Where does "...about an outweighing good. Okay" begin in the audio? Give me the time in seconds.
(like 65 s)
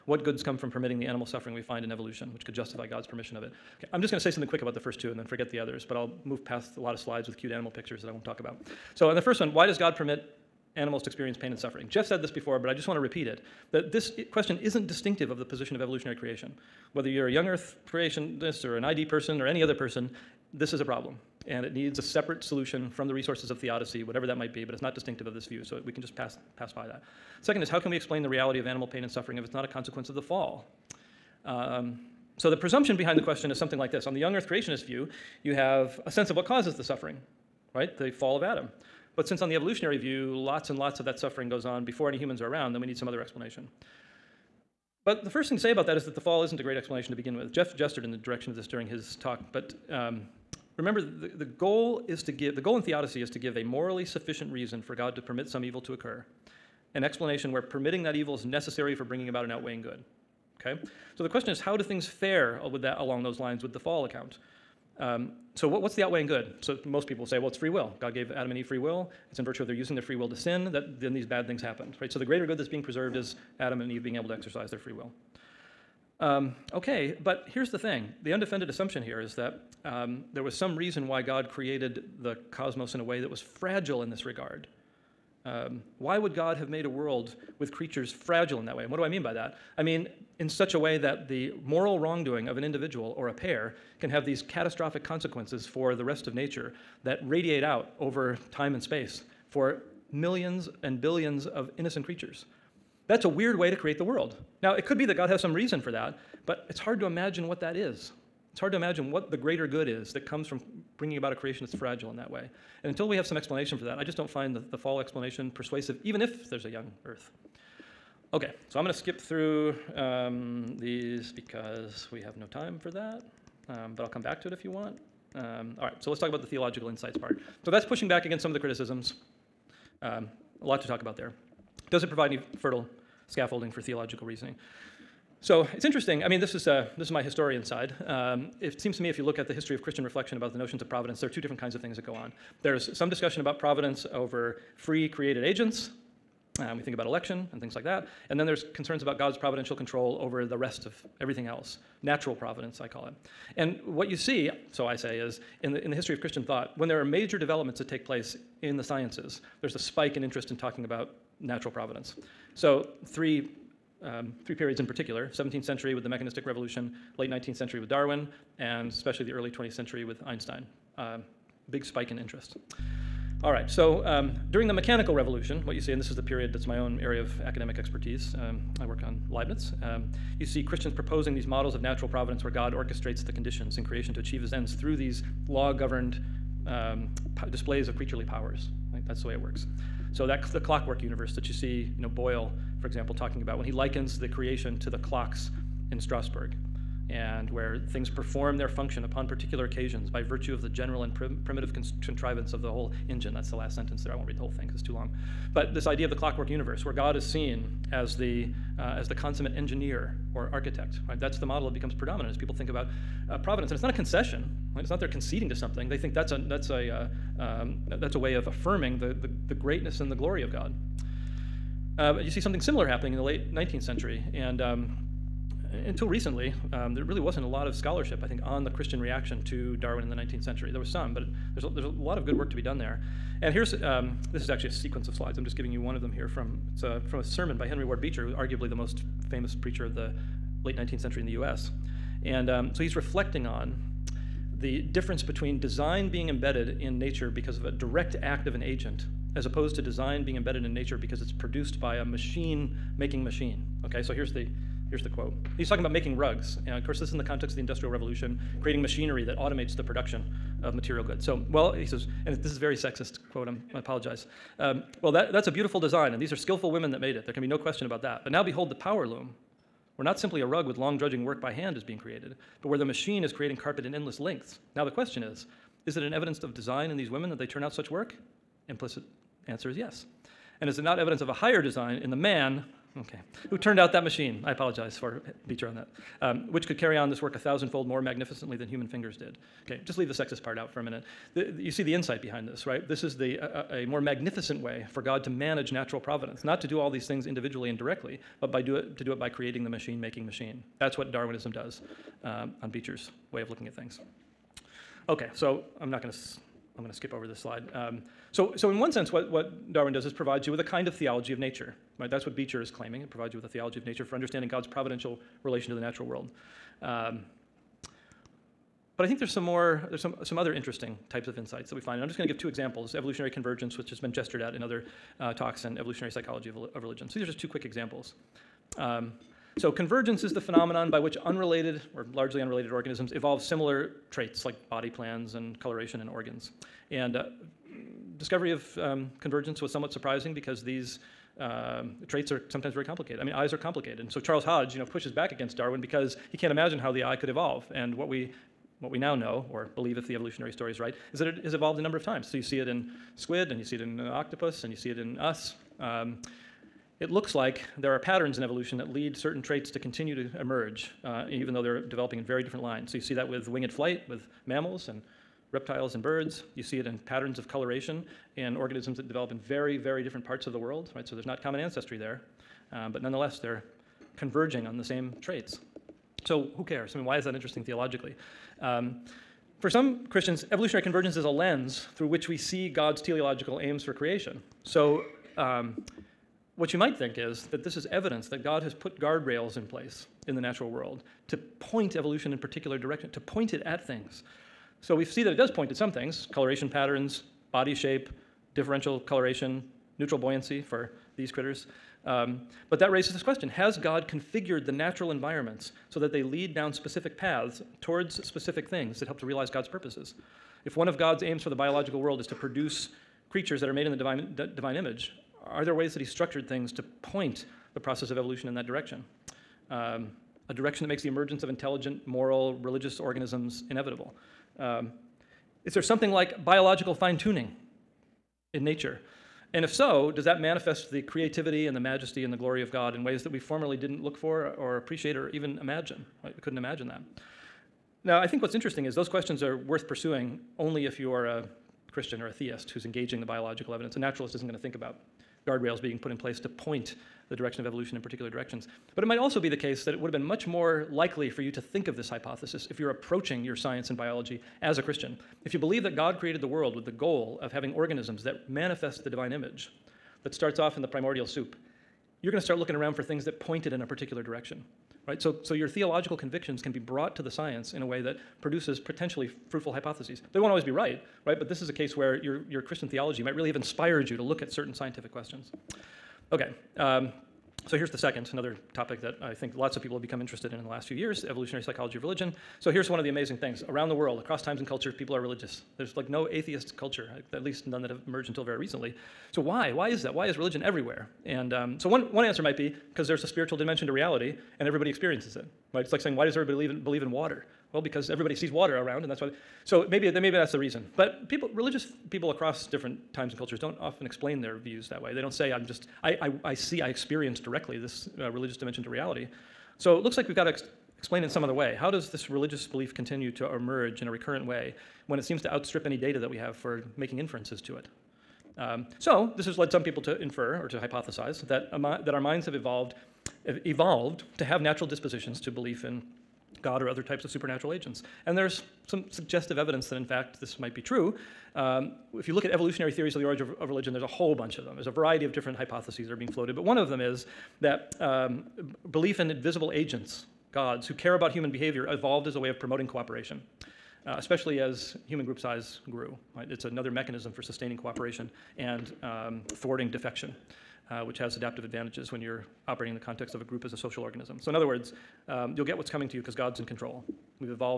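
59 s.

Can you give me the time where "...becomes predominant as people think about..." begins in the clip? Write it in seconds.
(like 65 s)
211 s.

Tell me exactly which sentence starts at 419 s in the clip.
Um, a direction that makes the emergence of intelligent, moral, religious organisms inevitable.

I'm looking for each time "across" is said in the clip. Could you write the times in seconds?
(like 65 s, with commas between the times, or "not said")
484 s, 502 s.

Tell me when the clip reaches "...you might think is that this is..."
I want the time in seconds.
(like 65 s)
386 s.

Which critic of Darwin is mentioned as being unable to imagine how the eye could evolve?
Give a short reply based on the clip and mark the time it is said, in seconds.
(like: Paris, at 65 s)
Charles Hodge, at 344 s.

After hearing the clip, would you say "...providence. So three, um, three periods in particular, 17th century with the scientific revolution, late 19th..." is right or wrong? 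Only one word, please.
wrong.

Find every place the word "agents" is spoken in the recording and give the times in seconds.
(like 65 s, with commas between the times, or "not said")
145 s, 248 s, 527 s, 539 s.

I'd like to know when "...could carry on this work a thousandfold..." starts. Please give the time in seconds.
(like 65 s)
286 s.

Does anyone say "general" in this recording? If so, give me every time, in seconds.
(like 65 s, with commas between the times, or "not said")
200 s.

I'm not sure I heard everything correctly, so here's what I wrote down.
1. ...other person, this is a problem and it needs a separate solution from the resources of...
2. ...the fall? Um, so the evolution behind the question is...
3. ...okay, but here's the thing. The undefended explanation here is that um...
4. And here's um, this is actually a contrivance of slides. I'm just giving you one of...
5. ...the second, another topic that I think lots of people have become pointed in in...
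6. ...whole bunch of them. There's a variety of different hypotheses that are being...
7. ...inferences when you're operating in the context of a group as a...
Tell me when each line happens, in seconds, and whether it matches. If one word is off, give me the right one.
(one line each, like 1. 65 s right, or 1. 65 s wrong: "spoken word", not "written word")
1. 19 s right
2. 30 s wrong: "presumption", not "evolution"
3. 76 s wrong: "assumption", not "explanation"
4. 233 s wrong: "sequence", not "contrivance"
5. 477 s wrong: "interested", not "pointed"
6. 534 s right
7. 551 s wrong: "advantages", not "inferences".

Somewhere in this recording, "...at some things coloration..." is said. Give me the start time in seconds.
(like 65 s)
395 s.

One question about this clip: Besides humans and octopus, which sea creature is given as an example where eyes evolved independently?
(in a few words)
squid.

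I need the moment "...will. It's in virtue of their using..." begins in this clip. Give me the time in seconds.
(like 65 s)
68 s.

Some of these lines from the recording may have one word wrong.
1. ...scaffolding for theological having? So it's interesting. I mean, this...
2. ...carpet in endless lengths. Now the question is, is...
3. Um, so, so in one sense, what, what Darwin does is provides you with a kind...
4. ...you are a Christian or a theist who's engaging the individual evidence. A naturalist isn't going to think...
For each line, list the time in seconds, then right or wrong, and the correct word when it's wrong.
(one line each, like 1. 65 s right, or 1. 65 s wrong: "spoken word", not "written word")
1. 133 s wrong: "reasoning", not "having"
2. 273 s right
3. 307 s right
4. 440 s wrong: "biological", not "individual".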